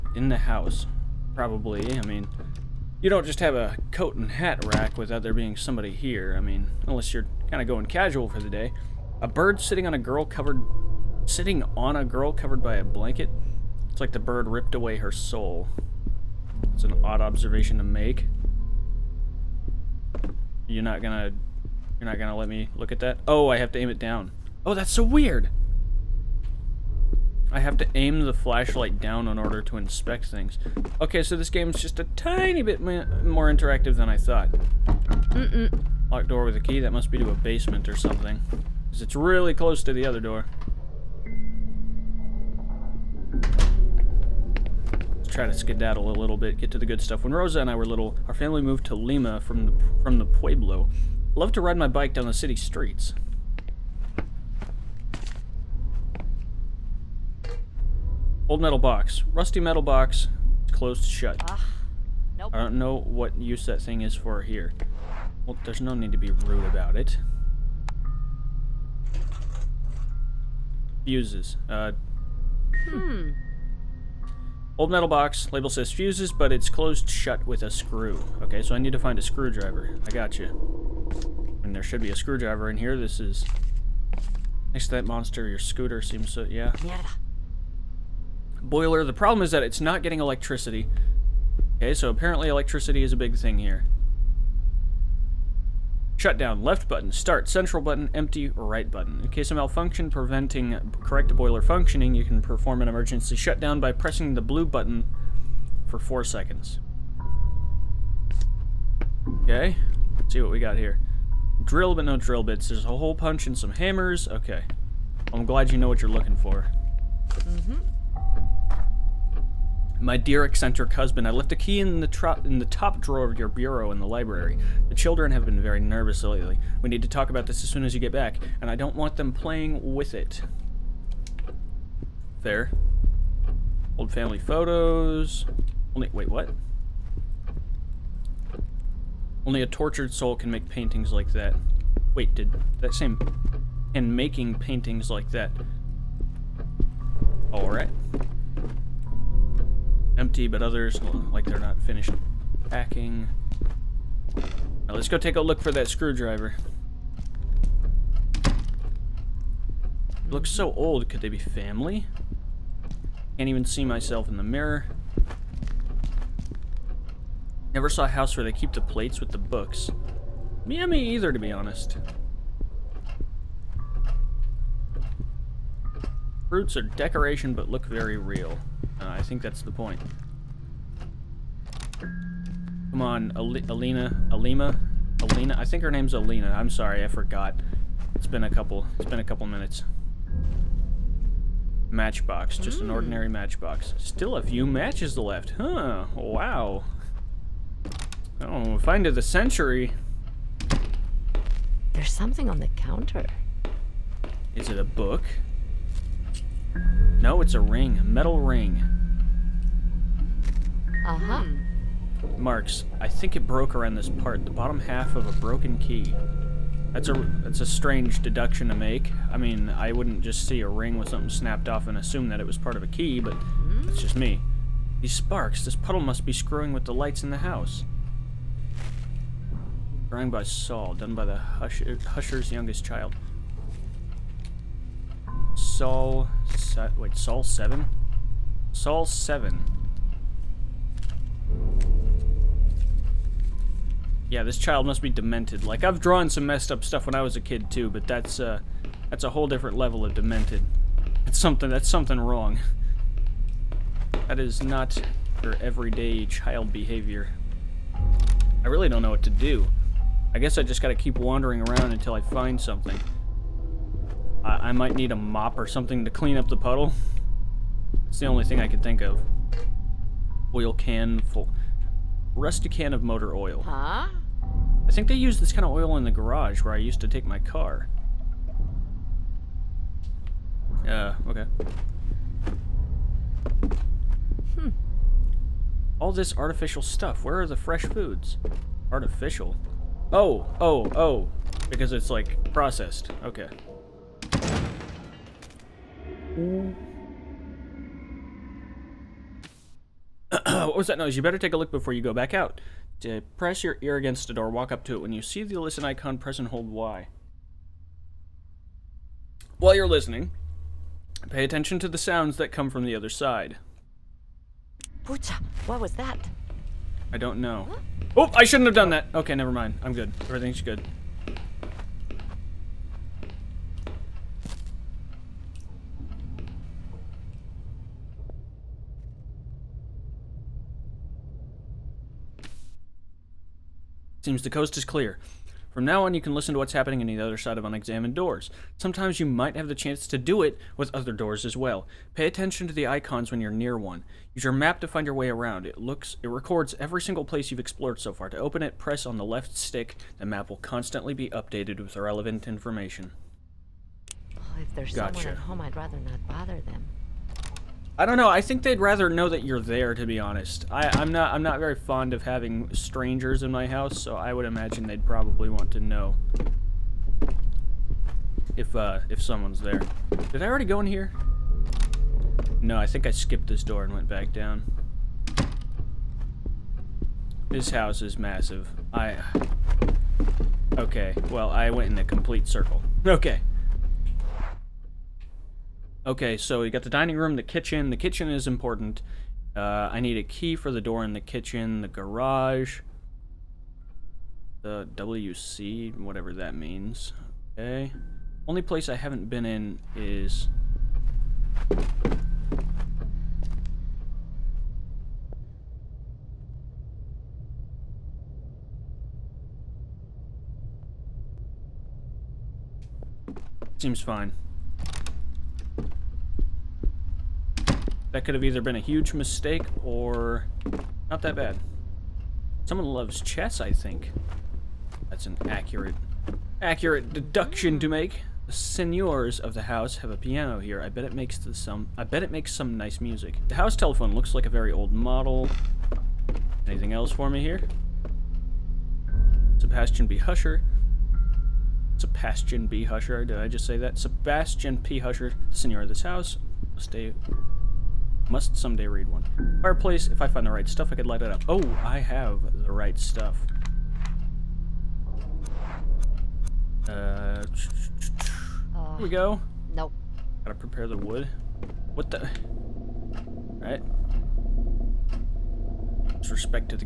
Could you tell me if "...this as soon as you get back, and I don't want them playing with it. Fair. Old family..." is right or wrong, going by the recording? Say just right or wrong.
right.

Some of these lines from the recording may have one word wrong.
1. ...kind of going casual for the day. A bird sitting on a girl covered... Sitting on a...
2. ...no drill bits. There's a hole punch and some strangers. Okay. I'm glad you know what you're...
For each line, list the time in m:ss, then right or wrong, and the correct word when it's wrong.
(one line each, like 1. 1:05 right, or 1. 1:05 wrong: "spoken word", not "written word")
1. 0:07 right
2. 1:52 wrong: "hammers", not "strangers".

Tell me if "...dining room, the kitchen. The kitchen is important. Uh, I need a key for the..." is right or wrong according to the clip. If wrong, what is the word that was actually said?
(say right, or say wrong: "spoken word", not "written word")
right.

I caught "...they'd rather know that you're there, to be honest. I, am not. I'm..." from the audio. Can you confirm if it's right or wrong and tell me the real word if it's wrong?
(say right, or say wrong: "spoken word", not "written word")
right.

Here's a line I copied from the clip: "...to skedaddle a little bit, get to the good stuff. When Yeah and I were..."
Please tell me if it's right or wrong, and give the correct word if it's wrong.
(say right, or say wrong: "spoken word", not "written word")
wrong: "Rosa", not "Yeah".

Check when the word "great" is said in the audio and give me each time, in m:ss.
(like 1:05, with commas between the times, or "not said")
not said.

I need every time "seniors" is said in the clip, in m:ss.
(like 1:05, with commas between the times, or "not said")
7:08, 7:25.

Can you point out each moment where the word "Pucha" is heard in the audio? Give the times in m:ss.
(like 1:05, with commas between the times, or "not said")
5:15.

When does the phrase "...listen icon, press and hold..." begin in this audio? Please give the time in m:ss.
5:05.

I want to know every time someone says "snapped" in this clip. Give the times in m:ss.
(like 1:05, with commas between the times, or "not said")
3:41.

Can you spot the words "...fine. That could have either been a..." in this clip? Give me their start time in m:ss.
6:54.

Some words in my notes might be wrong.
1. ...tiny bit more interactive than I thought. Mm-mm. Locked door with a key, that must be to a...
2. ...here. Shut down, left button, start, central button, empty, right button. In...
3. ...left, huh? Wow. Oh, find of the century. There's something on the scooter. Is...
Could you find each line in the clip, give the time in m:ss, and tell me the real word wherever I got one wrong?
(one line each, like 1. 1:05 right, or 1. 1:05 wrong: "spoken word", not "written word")
1. 0:32 right
2. 1:33 right
3. 3:15 wrong: "counter", not "scooter".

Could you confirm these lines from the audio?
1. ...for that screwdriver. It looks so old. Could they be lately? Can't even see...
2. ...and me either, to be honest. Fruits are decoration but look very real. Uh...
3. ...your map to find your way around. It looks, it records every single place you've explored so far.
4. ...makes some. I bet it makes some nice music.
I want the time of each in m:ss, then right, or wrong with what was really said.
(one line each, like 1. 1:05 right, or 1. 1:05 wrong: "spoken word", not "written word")
1. 2:35 wrong: "family", not "lately"
2. 2:50 right
3. 5:44 right
4. 7:11 right.